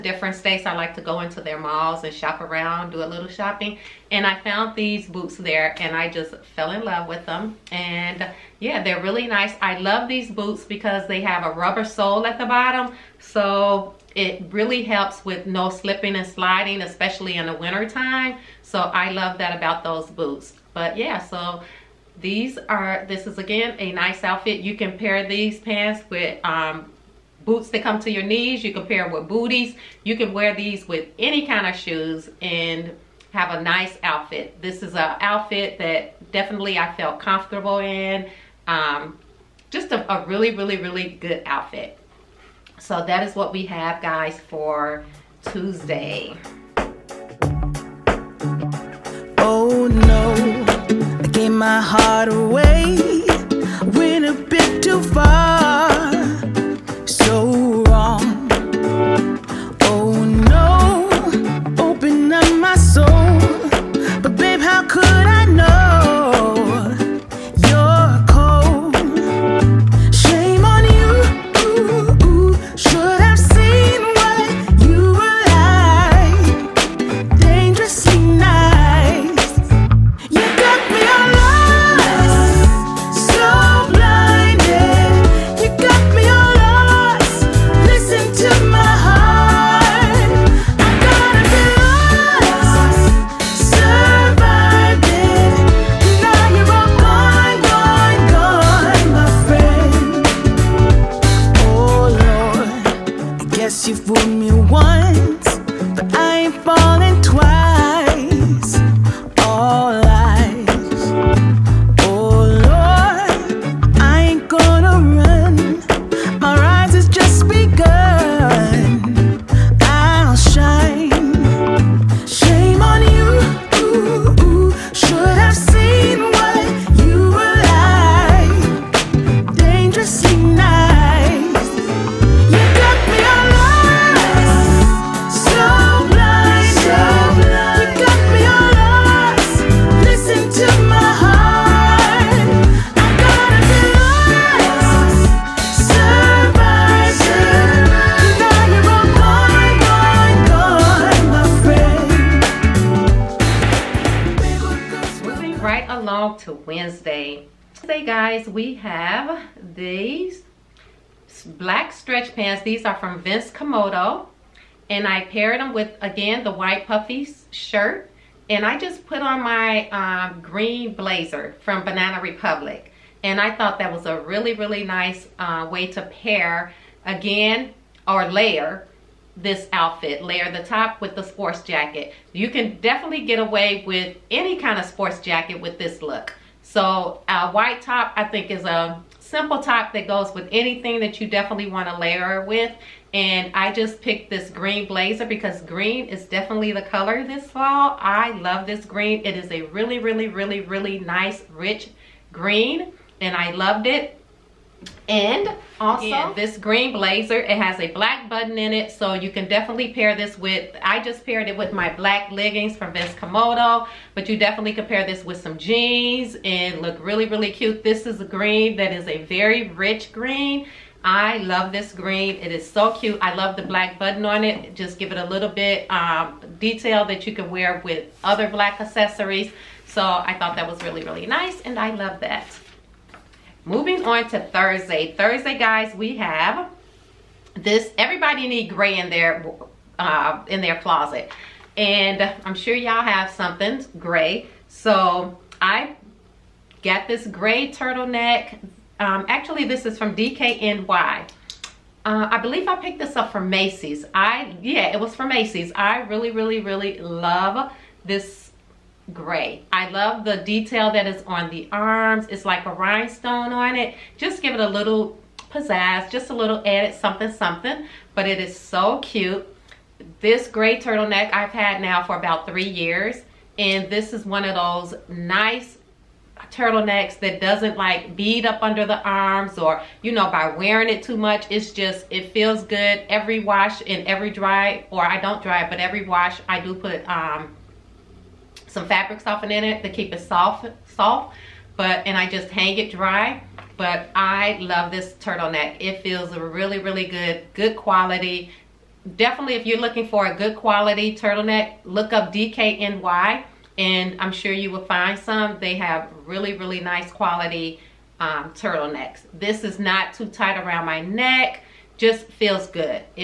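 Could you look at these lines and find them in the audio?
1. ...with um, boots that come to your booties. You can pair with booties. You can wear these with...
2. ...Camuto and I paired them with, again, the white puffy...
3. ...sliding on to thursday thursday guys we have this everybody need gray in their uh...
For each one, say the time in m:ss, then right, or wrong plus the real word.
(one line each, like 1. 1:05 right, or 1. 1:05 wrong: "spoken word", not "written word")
1. 0:26 wrong: "knees", not "booties"
2. 2:43 right
3. 3:53 wrong: "moving", not "sliding".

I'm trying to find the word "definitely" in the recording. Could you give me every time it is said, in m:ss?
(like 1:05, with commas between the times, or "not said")
0:36, 3:02, 3:11, 3:16, 3:29, 3:34, 4:59.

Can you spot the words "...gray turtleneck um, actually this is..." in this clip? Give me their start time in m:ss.
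4:07.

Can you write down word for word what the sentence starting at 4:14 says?
I, yeah, it was from Macy's.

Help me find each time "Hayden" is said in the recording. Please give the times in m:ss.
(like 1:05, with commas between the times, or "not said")
not said.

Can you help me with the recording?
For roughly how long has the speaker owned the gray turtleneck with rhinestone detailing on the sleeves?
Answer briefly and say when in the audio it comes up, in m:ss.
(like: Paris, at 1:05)
about 3 years, at 4:32.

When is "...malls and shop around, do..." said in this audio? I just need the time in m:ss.
0:01.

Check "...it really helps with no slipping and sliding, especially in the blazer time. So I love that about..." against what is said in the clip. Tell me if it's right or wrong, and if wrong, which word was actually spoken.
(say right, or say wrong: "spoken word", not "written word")
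wrong: "winter", not "blazer".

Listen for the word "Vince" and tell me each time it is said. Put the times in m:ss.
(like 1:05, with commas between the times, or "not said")
2:43, 3:32.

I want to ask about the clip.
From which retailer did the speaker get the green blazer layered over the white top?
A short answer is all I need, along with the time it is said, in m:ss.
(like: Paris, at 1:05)
Banana Republic, at 2:51.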